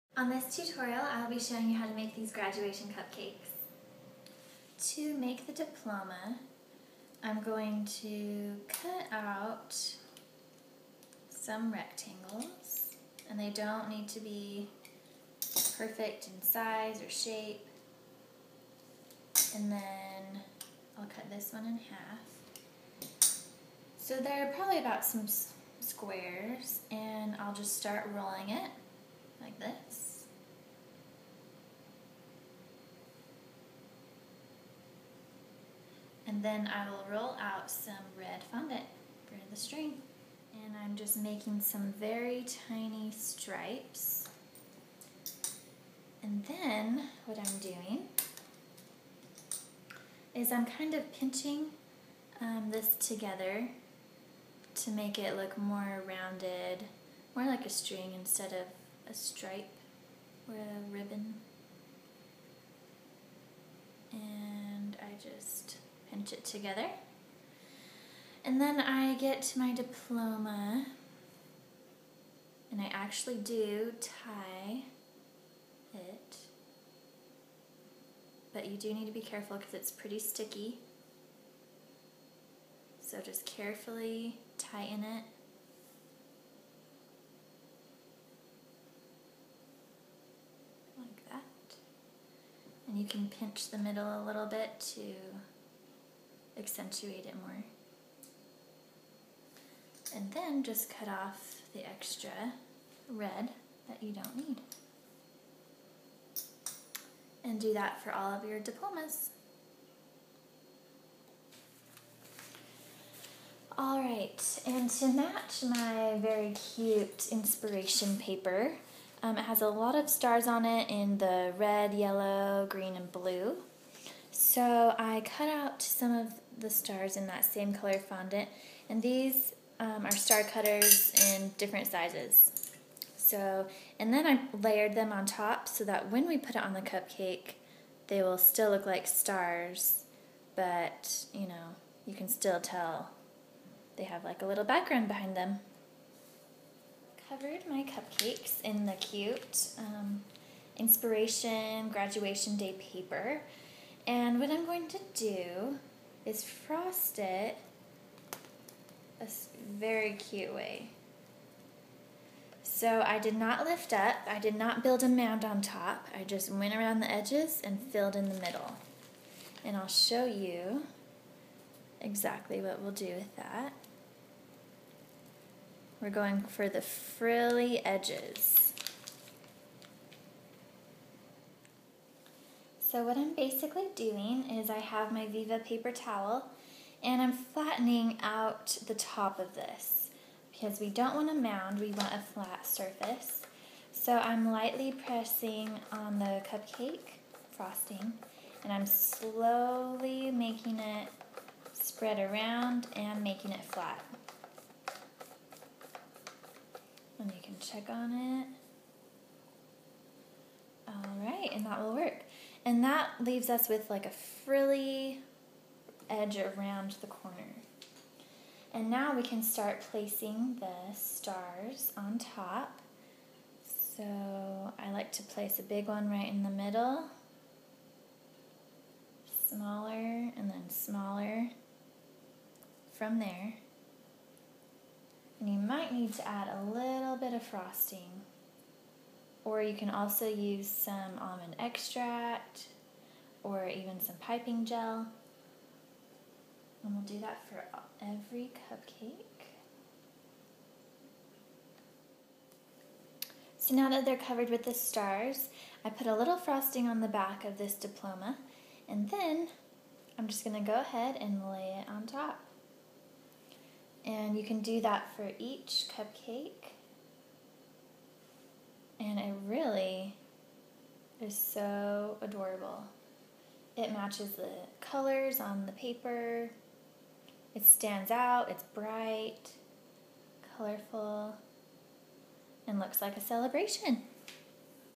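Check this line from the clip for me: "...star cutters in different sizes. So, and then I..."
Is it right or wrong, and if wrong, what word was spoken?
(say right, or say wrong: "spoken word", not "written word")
right.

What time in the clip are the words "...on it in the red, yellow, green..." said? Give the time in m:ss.
2:00.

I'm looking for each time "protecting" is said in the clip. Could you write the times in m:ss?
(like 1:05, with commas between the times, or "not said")
not said.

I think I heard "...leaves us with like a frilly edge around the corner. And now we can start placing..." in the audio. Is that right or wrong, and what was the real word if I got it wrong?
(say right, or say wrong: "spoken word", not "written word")
right.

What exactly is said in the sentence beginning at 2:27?
Covered my cupcakes in the cute um, inspiration graduation day paper.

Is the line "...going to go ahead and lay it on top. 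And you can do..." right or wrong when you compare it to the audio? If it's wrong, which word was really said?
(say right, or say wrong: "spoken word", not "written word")
right.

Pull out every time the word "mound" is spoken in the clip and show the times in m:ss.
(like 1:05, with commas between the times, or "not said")
2:45, 3:11.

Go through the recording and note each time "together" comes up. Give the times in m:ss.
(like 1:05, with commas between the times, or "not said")
0:52, 1:06.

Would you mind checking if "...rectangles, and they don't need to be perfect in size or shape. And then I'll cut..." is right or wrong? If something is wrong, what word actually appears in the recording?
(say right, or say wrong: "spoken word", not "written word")
right.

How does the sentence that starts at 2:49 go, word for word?
And I'll show you exactly what we'll do with that.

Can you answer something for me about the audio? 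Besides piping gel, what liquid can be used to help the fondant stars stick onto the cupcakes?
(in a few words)
Almond extract.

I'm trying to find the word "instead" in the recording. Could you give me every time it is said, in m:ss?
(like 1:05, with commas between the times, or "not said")
0:58.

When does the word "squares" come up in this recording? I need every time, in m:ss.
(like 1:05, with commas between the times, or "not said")
0:25.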